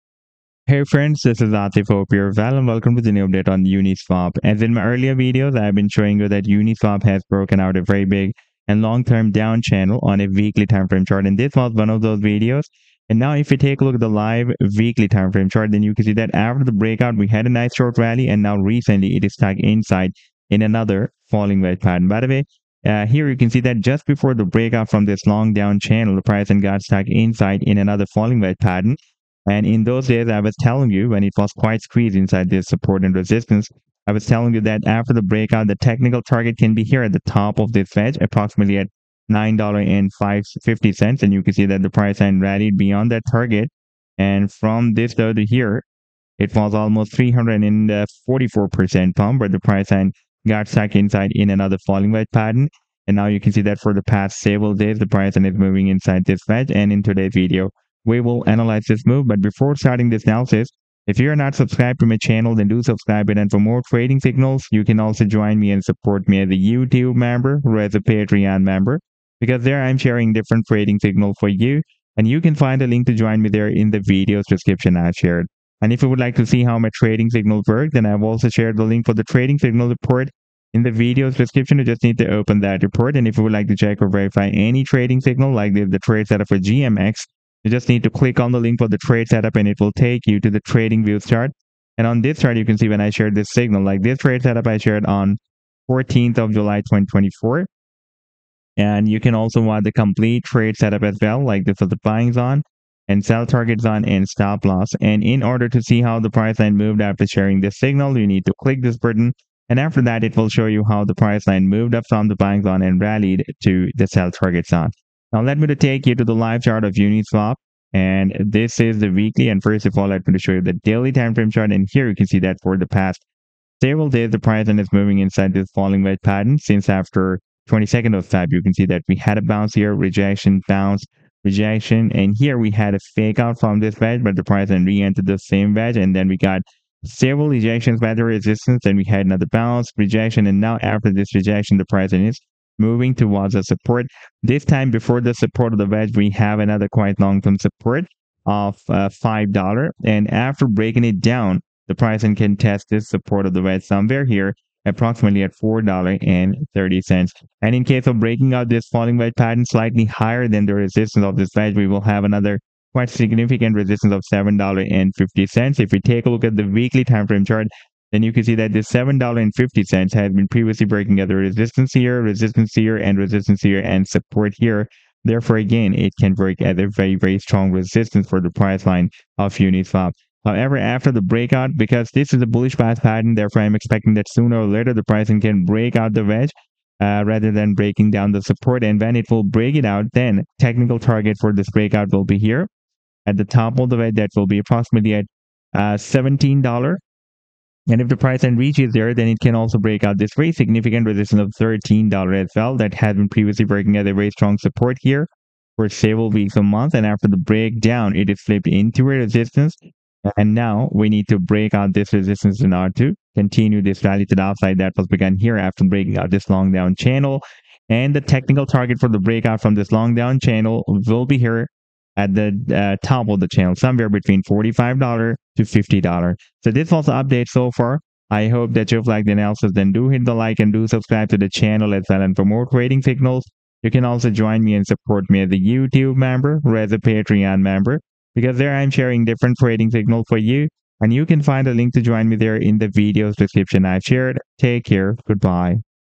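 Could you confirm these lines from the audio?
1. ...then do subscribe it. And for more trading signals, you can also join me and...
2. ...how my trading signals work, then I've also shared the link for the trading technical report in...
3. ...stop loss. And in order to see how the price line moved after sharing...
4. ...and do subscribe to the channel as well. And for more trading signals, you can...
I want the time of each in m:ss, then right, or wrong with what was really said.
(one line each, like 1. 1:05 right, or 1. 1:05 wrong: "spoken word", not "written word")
1. 1:02 right
2. 1:16 wrong: "signal", not "technical"
3. 1:44 right
4. 3:50 right.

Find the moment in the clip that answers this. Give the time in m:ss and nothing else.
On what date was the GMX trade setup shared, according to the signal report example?
1:35.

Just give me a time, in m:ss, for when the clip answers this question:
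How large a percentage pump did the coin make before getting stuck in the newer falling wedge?
0:47.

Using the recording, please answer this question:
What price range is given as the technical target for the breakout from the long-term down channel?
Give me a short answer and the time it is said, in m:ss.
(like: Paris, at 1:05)
$45 to $50, at 3:44.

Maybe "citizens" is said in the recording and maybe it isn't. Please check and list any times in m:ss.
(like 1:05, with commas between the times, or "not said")
not said.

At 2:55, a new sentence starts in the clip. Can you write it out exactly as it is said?
Therefore, again, it can break at a very, very strong resistance for the price line of Uniswap.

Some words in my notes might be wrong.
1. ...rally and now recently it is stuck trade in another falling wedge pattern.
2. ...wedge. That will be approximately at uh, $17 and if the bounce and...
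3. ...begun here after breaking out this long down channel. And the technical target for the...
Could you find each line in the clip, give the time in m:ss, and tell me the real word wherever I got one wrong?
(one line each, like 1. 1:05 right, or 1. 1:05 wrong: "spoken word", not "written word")
1. 0:17 wrong: "inside", not "trade"
2. 3:13 wrong: "price", not "bounce"
3. 3:35 right.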